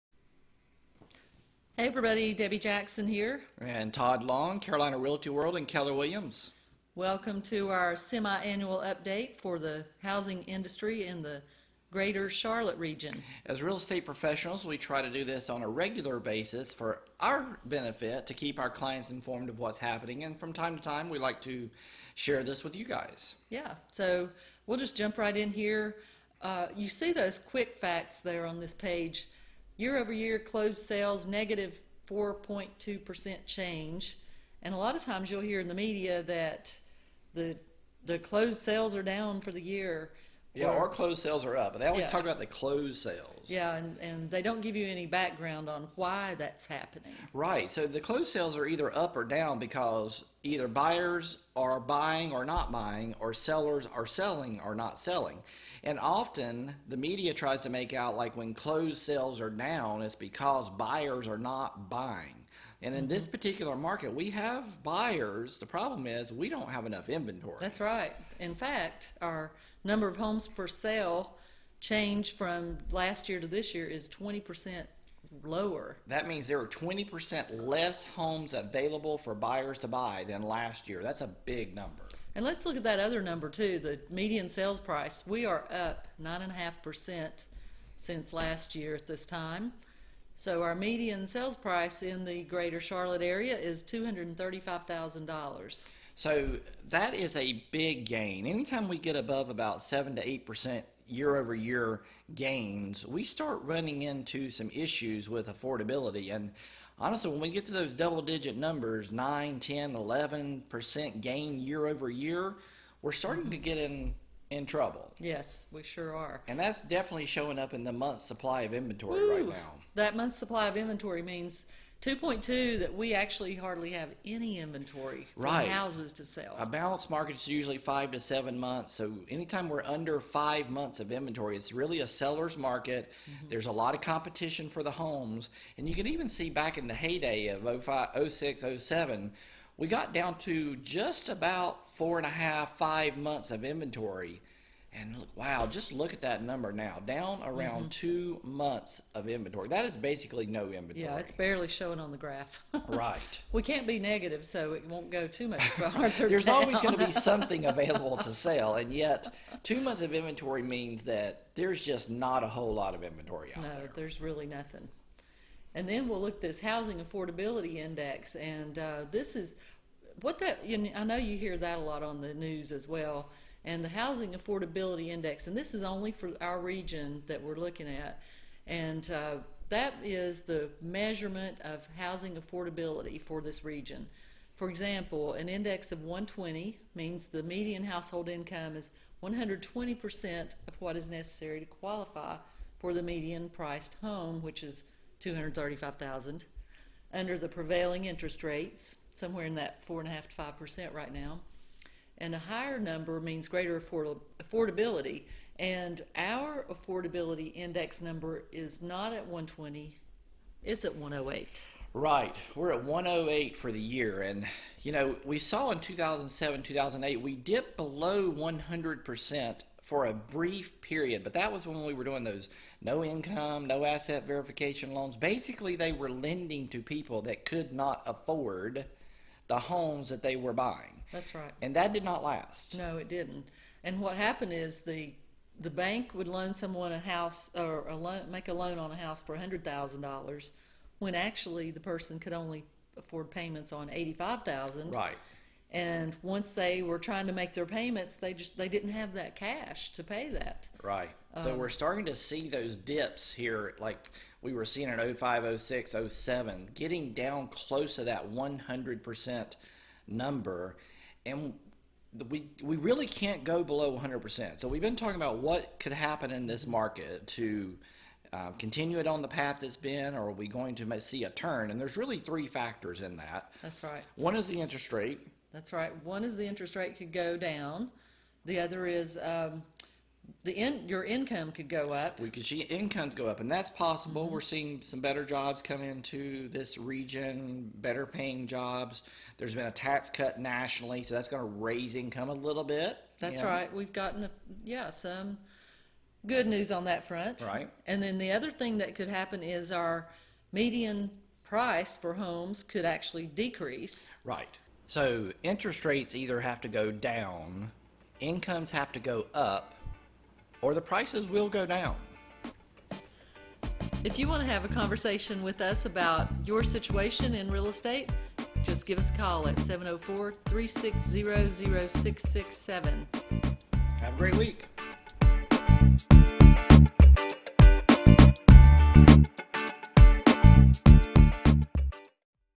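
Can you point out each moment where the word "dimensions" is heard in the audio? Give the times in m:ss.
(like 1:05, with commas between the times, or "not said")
not said.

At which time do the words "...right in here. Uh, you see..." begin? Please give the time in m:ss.
0:25.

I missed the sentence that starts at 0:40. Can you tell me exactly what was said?
Yeah, our closed sales are up, and they always yeah.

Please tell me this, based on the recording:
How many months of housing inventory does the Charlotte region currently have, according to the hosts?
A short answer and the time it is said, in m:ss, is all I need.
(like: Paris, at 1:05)
2.2, at 2:02.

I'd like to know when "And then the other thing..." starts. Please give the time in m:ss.
4:57.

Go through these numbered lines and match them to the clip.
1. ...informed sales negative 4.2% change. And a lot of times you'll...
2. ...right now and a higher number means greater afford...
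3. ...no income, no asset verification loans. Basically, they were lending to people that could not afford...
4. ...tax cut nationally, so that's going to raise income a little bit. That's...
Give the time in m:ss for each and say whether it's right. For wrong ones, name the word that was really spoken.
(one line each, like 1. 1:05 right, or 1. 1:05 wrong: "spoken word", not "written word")
1. 0:30 wrong: "closed", not "informed"
2. 3:20 right
3. 3:42 right
4. 4:49 right.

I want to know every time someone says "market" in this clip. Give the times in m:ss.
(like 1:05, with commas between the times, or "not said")
1:03, 2:07, 2:12, 4:26.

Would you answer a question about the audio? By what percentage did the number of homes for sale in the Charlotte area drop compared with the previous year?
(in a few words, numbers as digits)
20%.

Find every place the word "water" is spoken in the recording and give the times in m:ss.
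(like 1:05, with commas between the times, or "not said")
not said.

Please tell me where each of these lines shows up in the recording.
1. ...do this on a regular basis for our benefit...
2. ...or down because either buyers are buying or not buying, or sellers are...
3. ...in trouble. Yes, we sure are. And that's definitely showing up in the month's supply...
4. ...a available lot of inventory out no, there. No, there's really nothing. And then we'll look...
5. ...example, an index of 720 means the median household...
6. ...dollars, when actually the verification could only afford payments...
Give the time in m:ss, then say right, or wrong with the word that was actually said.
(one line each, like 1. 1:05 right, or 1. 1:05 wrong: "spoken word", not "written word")
1. 0:15 right
2. 0:49 right
3. 1:54 right
4. 2:42 wrong: "whole", not "available"
5. 3:04 wrong: "120", not "720"
6. 3:59 wrong: "person", not "verification".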